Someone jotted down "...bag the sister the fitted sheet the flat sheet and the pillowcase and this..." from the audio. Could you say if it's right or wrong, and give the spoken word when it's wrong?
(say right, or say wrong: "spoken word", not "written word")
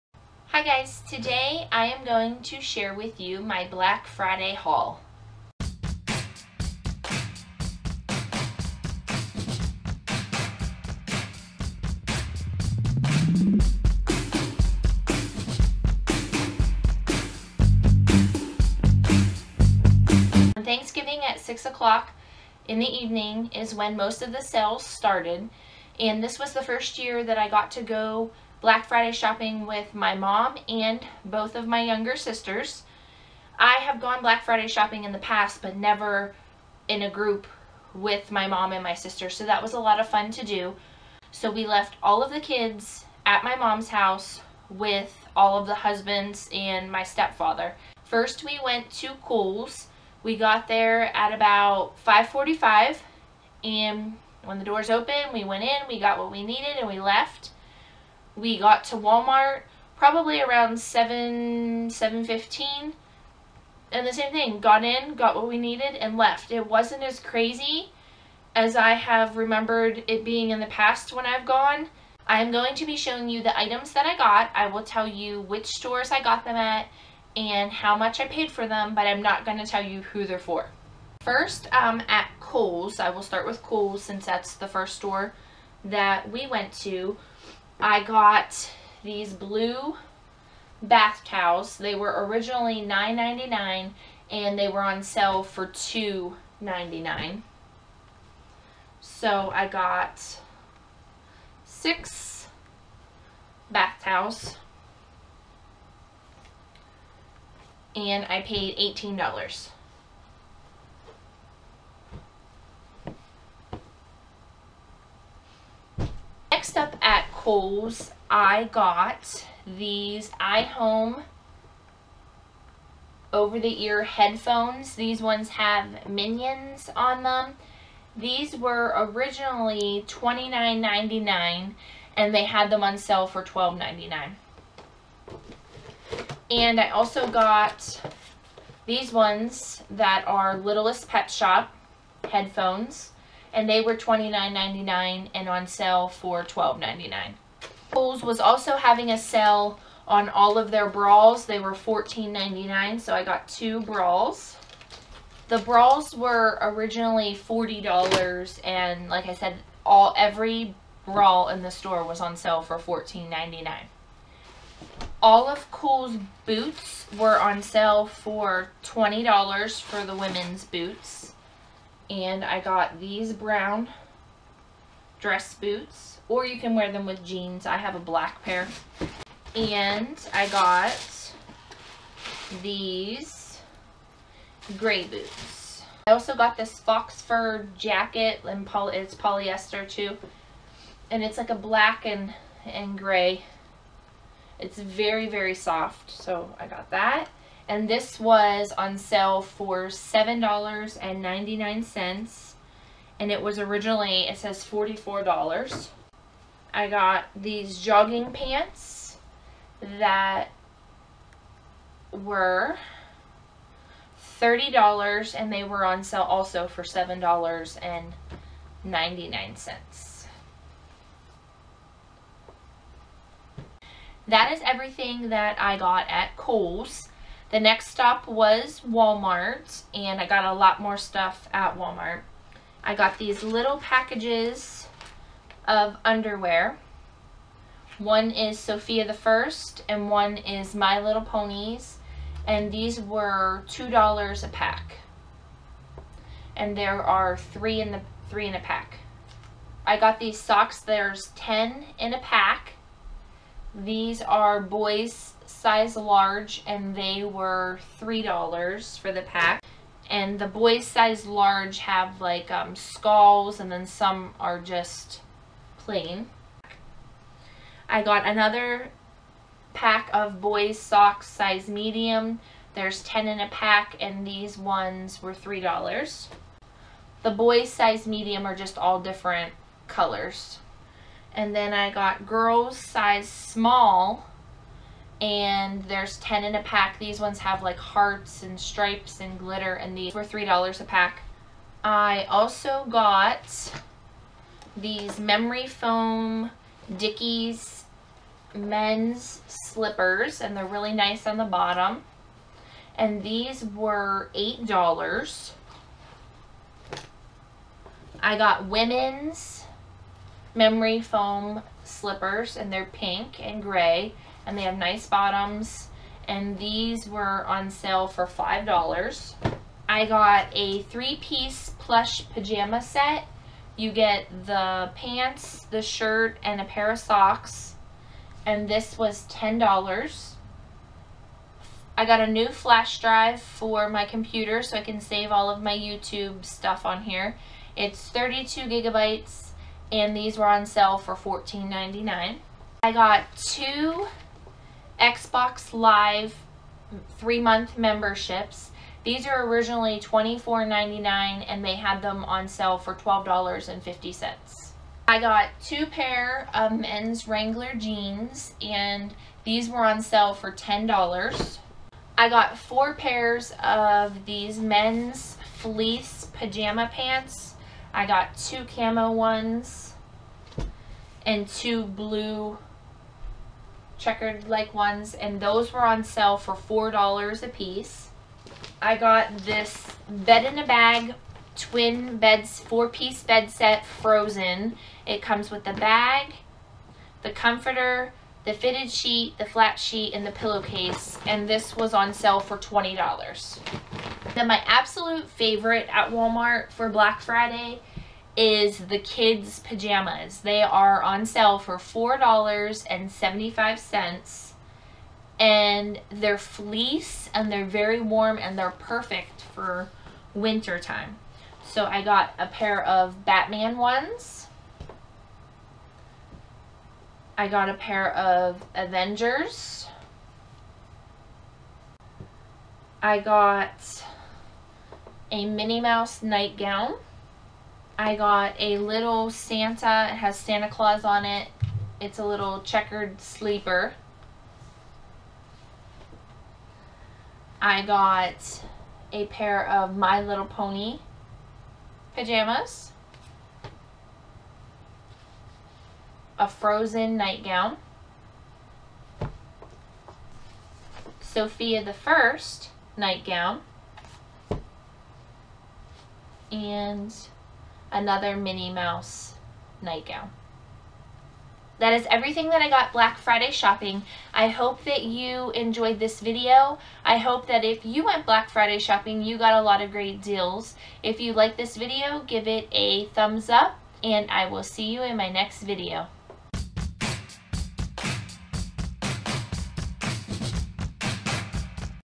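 wrong: "comforter", not "sister".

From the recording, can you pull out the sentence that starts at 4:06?
And there are three in the three in a pack.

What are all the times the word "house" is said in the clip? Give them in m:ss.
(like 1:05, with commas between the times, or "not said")
0:43.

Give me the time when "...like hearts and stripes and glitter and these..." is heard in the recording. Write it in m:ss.
4:47.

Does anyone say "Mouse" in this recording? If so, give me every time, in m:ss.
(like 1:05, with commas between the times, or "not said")
7:05, 7:38.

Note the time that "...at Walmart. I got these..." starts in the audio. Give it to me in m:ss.
3:51.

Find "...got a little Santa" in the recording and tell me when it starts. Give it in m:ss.
7:08.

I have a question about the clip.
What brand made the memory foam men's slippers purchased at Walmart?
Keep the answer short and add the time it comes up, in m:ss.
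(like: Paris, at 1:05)
Dickies, at 4:56.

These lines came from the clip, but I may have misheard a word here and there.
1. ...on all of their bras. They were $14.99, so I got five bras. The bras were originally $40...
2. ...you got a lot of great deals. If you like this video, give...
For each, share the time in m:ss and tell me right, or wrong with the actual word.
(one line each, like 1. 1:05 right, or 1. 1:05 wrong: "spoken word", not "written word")
1. 2:30 wrong: "two", not "five"
2. 7:49 right.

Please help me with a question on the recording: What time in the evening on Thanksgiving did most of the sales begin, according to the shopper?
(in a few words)
6 o'clock.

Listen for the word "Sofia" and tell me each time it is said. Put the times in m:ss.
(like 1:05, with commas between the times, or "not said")
3:58, 7:31.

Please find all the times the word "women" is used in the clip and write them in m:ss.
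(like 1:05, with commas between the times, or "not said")
2:50, 5:08.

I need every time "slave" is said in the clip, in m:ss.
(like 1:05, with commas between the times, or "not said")
not said.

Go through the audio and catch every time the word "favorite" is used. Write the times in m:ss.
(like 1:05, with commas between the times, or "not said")
6:35.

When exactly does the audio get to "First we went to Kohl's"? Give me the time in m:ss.
0:48.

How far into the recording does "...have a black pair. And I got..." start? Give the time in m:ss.
2:57.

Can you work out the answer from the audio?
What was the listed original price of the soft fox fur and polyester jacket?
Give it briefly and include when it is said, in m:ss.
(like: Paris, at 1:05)
$44, at 3:24.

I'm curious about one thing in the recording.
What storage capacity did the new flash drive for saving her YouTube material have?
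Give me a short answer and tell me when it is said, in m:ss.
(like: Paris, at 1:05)
32 gigabytes, at 5:38.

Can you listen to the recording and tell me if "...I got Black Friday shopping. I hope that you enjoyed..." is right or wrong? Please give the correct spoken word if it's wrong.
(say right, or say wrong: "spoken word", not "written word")
right.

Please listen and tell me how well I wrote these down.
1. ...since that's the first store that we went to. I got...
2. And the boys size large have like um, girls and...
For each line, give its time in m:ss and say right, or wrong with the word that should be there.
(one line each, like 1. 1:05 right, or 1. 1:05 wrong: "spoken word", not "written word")
1. 1:24 right
2. 4:20 wrong: "skulls", not "girls".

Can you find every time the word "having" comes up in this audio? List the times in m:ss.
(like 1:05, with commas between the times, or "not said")
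2:28.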